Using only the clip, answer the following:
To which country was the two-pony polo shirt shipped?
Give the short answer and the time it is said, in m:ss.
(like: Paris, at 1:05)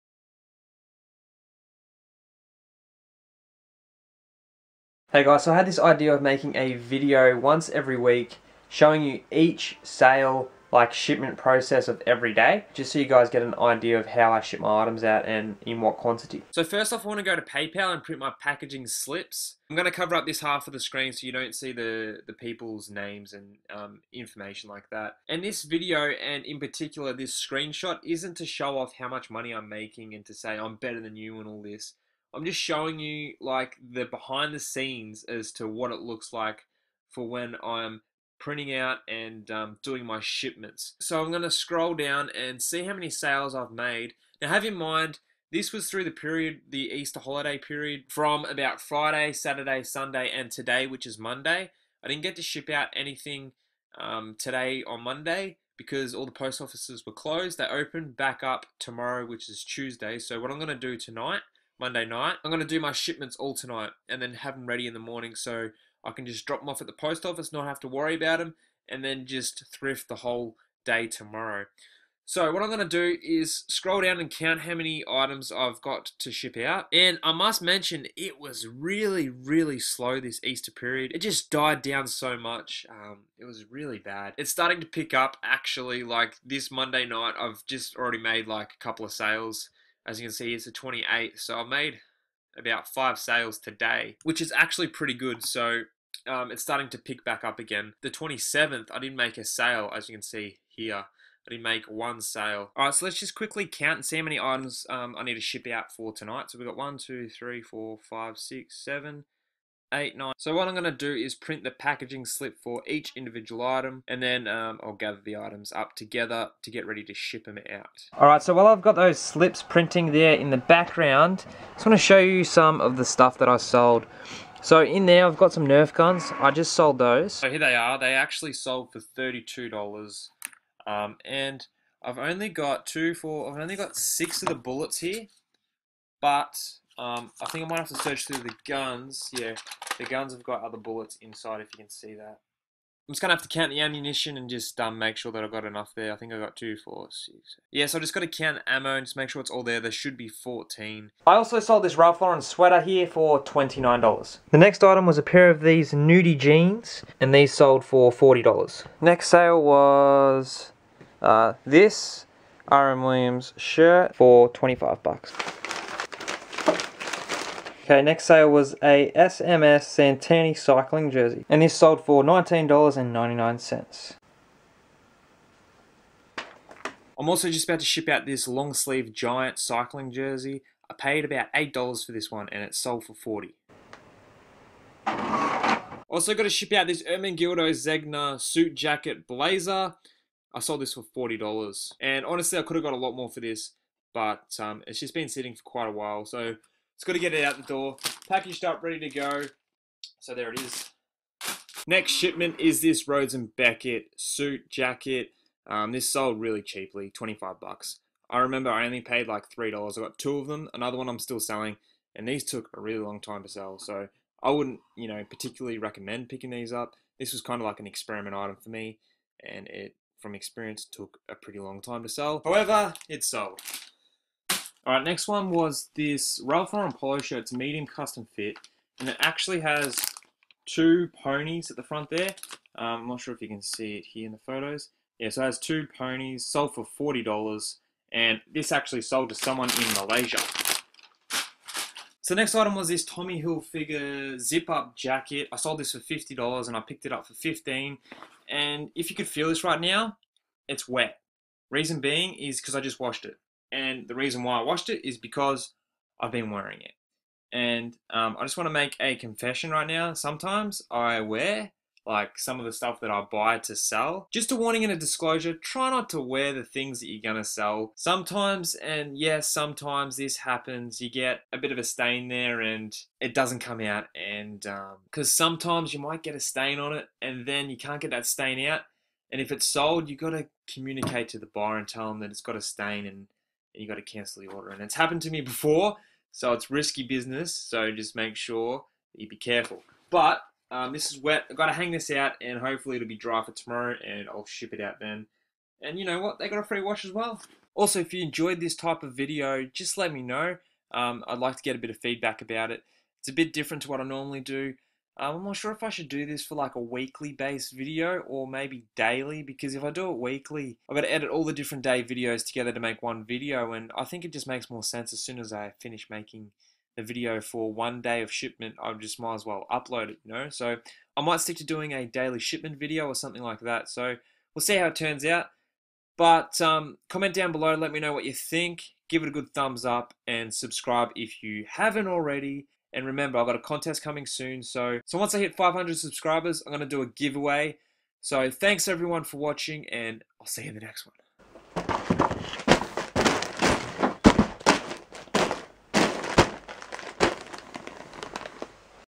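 Malaysia, at 3:59.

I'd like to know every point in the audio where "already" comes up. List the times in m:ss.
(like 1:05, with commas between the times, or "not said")
1:27, 5:32.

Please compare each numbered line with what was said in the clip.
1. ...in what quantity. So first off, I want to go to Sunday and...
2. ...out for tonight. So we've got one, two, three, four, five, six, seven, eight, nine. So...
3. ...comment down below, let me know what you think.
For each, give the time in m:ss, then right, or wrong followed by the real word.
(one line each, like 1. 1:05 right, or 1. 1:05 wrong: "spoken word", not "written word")
1. 0:15 wrong: "PayPal", not "Sunday"
2. 1:45 right
3. 5:27 right.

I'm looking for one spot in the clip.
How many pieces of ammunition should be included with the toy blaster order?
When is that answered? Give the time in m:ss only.
2:30.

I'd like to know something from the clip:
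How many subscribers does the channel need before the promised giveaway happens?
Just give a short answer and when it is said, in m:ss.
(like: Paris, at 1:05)
500, at 5:35.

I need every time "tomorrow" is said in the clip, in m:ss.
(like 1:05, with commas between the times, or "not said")
0:58, 1:11, 4:53.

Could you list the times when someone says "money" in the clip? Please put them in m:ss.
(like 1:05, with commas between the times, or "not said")
0:29.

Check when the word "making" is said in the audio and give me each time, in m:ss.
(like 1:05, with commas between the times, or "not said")
0:06, 0:29, 5:16.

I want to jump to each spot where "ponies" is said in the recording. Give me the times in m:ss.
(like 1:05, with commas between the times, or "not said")
3:51, 3:55.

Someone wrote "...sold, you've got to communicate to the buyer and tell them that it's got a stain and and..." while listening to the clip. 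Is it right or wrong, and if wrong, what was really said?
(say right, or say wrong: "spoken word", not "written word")
right.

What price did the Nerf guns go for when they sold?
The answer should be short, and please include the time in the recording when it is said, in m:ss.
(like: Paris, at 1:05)
$32, at 2:08.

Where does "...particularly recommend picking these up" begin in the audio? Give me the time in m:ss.
3:35.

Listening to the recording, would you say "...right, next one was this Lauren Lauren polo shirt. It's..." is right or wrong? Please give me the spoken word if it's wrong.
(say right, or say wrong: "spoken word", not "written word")
wrong: "Ralph", not "Lauren".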